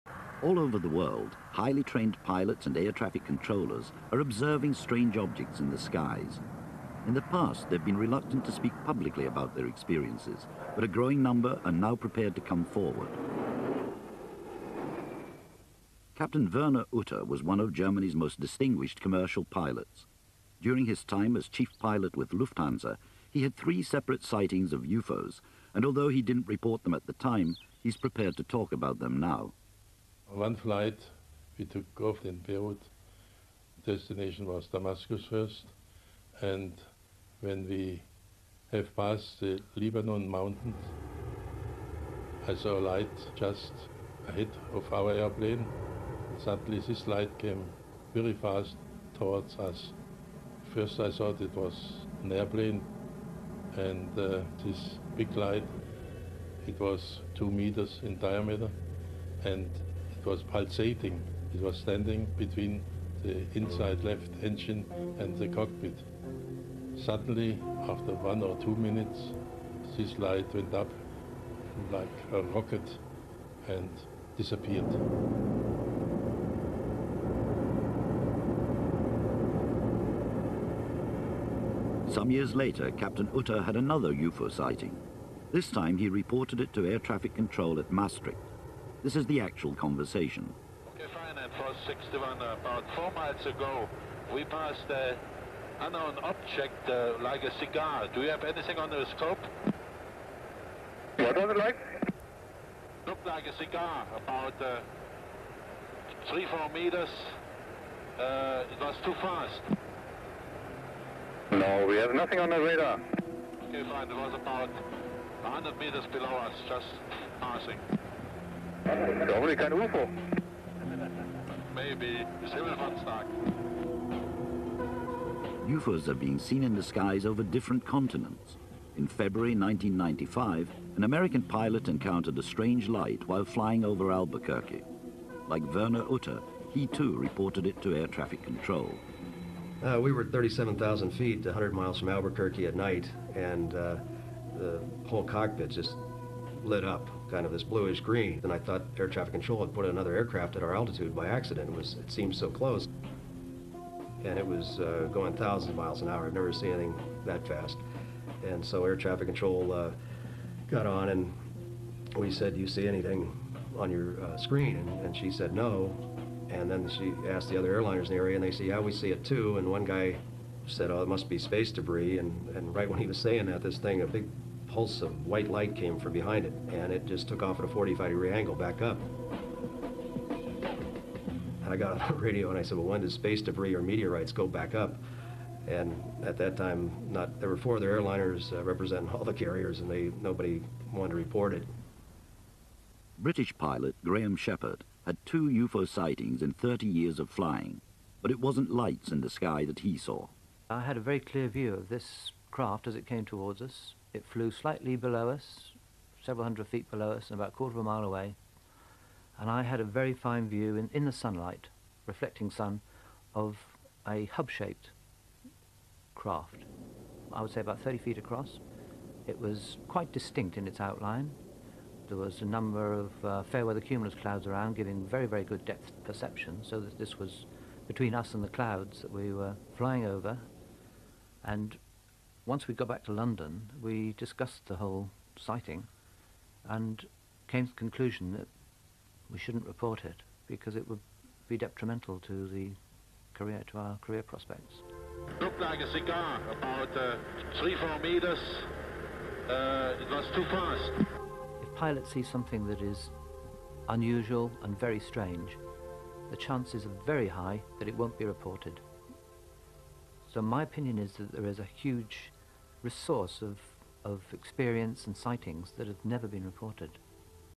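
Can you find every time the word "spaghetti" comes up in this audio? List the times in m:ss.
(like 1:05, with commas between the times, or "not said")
not said.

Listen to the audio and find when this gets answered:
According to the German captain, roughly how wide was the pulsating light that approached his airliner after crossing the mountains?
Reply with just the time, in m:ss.
0:57.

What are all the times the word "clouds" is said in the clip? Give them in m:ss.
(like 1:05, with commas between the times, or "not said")
3:44, 3:48.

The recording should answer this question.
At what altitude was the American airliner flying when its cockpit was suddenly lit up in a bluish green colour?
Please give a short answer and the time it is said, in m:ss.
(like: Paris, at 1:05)
37,000 feet, at 2:20.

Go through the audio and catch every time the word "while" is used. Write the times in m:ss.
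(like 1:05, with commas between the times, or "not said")
2:13.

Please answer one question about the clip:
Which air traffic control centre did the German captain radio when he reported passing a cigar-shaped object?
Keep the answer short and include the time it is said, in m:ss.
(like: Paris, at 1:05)
Maastricht, at 1:27.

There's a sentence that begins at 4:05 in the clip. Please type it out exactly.
It looked like a cigar, about uh, three, four meters.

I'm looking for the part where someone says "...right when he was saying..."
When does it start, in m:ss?
2:52.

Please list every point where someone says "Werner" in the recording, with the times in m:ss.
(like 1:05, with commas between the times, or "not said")
0:16, 2:15.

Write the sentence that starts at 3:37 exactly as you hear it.
I would say about 30 feet across.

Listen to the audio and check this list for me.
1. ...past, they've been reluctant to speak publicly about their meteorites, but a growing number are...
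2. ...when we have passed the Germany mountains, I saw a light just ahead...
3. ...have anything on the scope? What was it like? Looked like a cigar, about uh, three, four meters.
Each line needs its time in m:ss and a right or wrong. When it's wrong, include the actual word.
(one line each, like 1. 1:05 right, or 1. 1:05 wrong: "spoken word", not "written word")
1. 0:07 wrong: "experiences", not "meteorites"
2. 0:37 wrong: "Lebanon", not "Germany"
3. 1:38 right.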